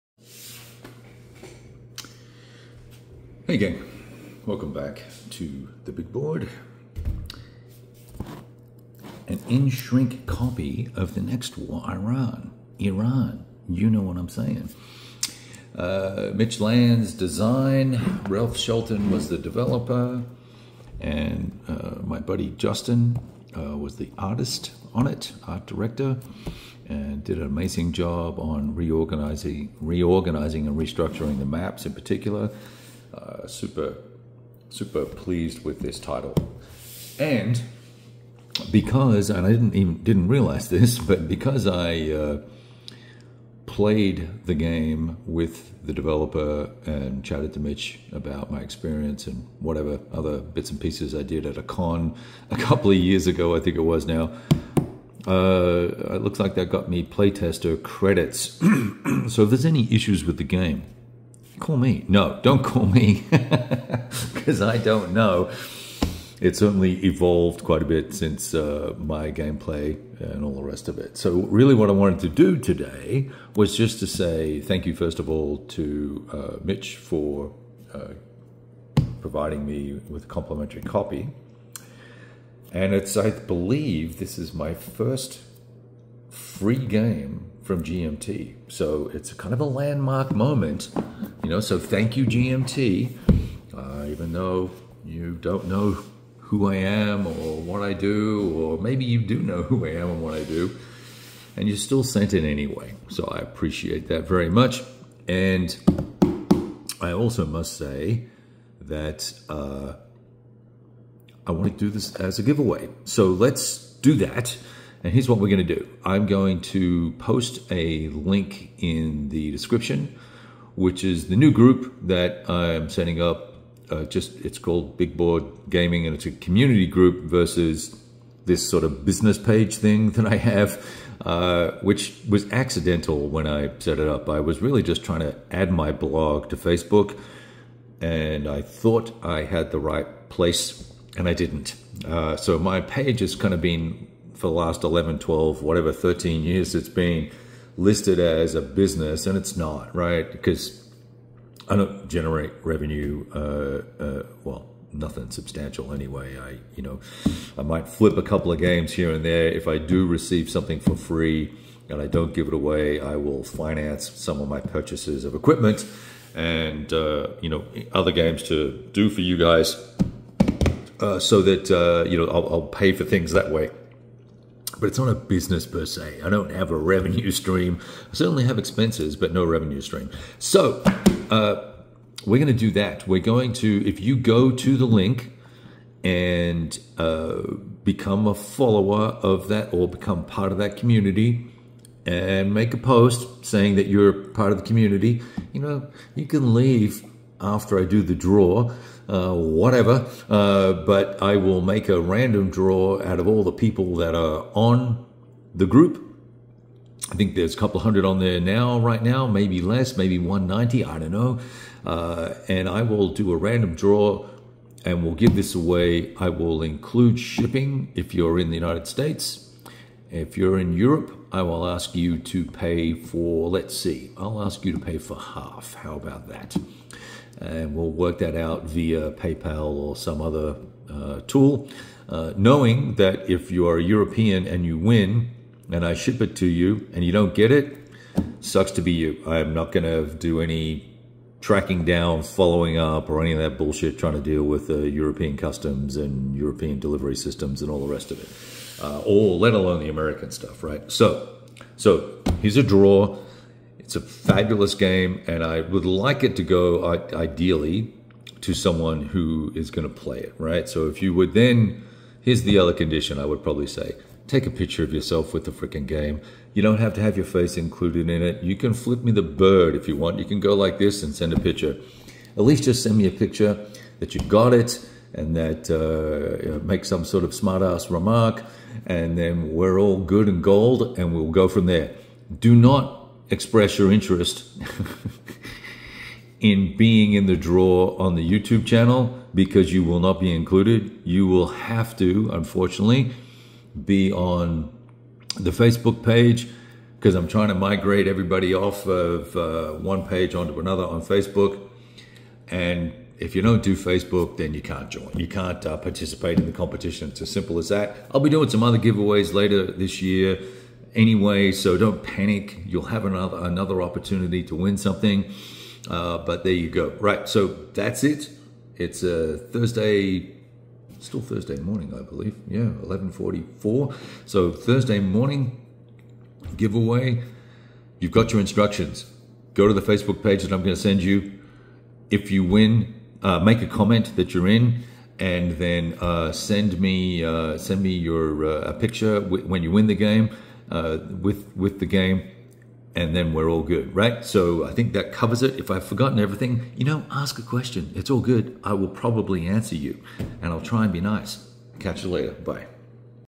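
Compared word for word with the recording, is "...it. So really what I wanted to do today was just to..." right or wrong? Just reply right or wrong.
right.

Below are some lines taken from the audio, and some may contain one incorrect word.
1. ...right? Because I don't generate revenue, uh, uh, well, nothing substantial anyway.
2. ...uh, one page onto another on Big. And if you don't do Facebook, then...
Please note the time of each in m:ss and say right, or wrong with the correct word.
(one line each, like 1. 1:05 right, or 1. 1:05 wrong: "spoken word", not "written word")
1. 2:29 right
2. 4:59 wrong: "Facebook", not "Big".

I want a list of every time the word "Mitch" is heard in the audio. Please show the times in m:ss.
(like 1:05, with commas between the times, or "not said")
0:16, 0:47, 1:16.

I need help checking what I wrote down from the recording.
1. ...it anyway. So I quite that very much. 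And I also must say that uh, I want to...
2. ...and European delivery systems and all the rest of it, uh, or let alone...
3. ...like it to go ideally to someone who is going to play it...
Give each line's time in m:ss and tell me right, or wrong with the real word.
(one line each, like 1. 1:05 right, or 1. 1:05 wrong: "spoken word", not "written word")
1. 1:42 wrong: "appreciate", not "quite"
2. 4:05 right
3. 4:15 right.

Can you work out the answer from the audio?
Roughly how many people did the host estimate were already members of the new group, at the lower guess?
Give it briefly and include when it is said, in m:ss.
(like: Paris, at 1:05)
190, at 3:30.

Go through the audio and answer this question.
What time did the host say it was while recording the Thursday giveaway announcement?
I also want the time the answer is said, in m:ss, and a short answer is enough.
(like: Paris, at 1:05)
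11:44, at 5:22.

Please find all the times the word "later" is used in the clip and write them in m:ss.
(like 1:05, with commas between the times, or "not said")
5:09, 5:52.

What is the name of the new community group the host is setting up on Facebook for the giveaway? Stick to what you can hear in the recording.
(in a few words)
Big Board Gaming.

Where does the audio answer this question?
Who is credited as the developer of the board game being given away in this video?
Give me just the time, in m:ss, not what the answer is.
0:18.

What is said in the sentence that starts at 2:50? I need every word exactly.
Uh, so that uh, you know I'll, I'll, pay for things that way but it's not a business per se.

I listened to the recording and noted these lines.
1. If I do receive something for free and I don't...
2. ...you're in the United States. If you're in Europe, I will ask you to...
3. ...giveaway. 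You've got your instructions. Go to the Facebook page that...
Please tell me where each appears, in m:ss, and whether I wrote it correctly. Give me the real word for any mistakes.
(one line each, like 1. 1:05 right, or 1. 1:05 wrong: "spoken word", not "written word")
1. 2:39 right
2. 3:38 right
3. 5:26 right.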